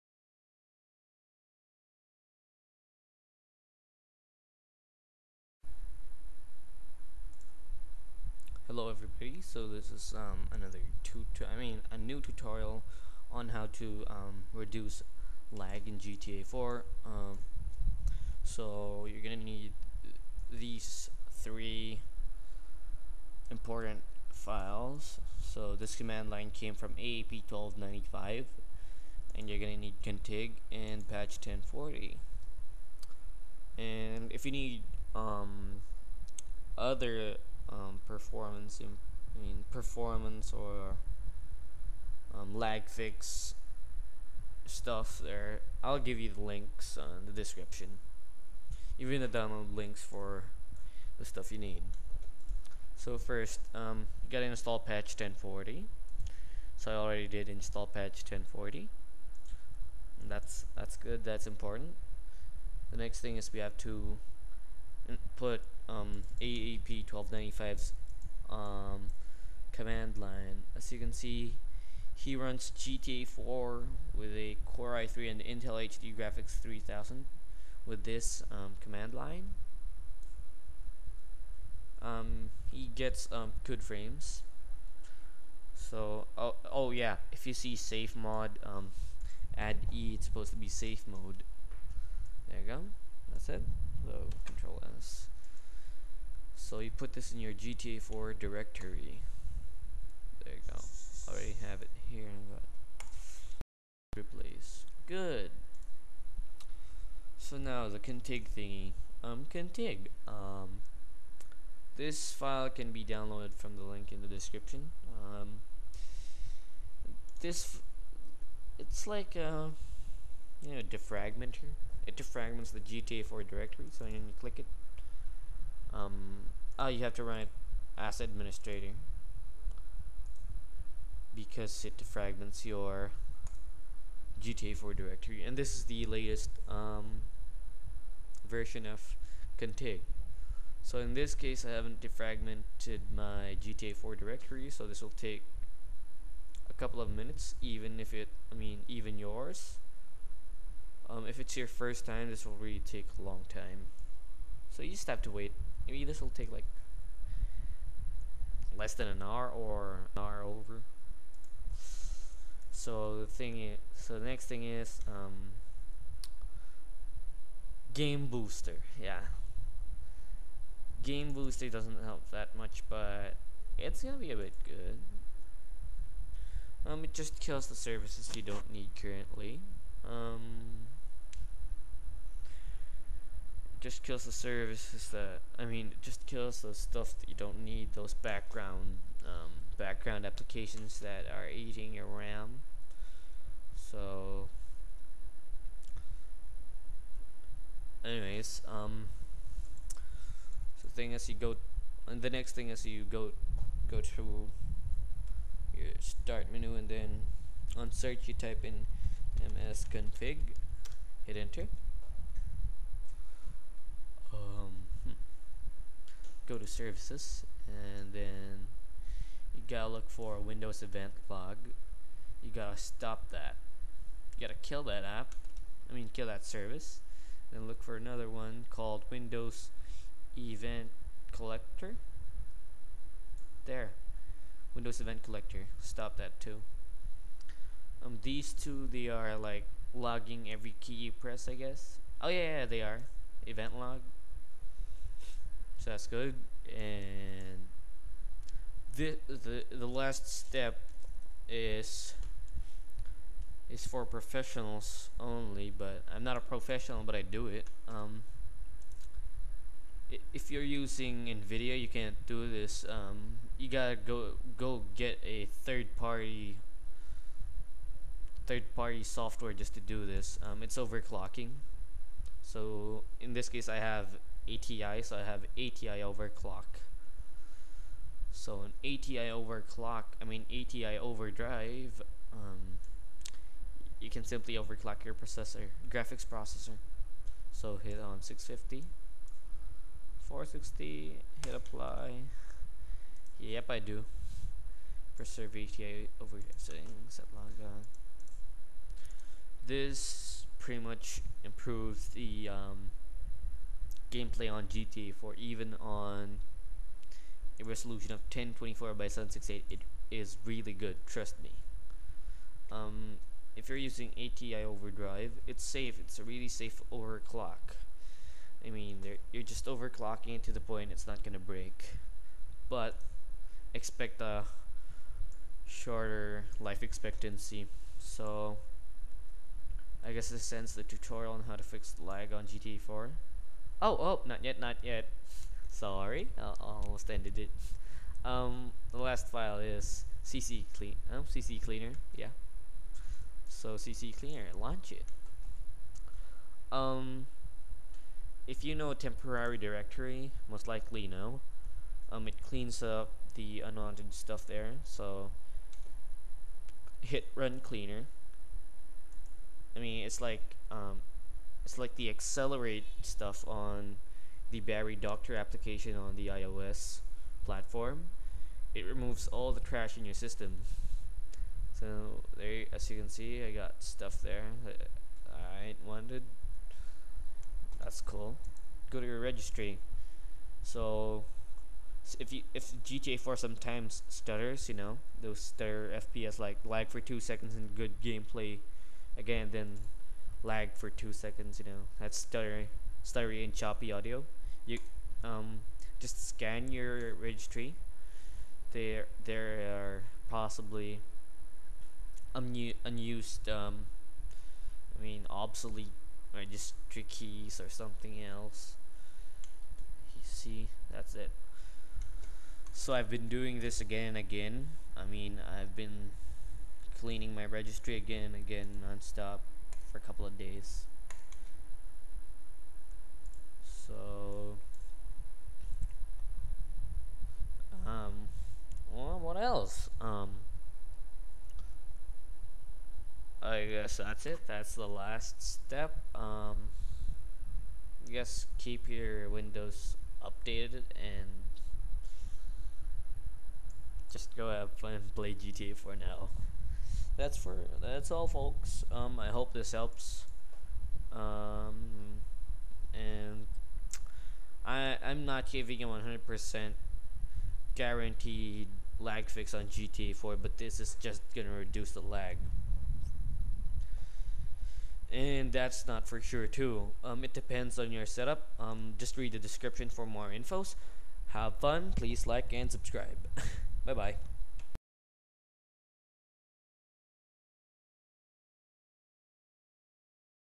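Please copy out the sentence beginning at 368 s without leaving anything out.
It removes all the trash in your system.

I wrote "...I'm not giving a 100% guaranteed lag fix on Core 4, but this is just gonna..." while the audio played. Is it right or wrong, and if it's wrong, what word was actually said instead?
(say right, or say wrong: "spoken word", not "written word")
wrong: "GTA", not "Core".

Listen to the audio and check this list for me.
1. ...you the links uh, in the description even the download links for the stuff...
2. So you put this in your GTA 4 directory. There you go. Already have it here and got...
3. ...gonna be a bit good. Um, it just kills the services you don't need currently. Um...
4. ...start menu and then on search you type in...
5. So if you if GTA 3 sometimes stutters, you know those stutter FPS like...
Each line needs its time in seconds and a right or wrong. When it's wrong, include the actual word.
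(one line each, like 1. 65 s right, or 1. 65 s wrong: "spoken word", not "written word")
1. 46 s right
2. 96 s right
3. 174 s right
4. 205 s right
5. 380 s wrong: "4", not "3".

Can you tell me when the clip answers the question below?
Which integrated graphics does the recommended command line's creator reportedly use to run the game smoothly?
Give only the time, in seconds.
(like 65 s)
75 s.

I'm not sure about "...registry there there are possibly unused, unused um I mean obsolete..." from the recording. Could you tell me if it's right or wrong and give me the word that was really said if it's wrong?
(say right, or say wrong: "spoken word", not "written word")
right.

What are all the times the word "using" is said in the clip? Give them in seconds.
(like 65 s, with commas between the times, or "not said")
260 s, 313 s.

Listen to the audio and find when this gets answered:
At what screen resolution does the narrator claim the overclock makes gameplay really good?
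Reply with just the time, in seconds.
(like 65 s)
308 s.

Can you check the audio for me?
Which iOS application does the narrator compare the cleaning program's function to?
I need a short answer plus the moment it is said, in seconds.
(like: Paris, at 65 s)
Battery Doctor, at 364 s.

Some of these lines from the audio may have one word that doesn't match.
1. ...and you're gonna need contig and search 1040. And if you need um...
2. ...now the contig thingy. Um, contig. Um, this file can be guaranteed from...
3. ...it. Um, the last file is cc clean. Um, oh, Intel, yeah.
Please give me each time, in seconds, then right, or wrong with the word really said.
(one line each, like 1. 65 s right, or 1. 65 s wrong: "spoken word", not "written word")
1. 29 s wrong: "patch", not "search"
2. 107 s wrong: "downloaded", not "guaranteed"
3. 337 s wrong: "CCleaner", not "Intel".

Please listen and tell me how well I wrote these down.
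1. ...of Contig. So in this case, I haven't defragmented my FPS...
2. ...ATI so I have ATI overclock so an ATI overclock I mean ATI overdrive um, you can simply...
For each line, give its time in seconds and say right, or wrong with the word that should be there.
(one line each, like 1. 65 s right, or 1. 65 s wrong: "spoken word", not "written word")
1. 138 s wrong: "GTA", not "FPS"
2. 274 s right.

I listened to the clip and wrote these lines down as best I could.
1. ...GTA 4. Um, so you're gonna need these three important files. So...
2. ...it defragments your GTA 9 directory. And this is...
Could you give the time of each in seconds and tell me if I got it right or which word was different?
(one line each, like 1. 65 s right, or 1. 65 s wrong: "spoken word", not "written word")
1. 15 s right
2. 131 s wrong: "4", not "9".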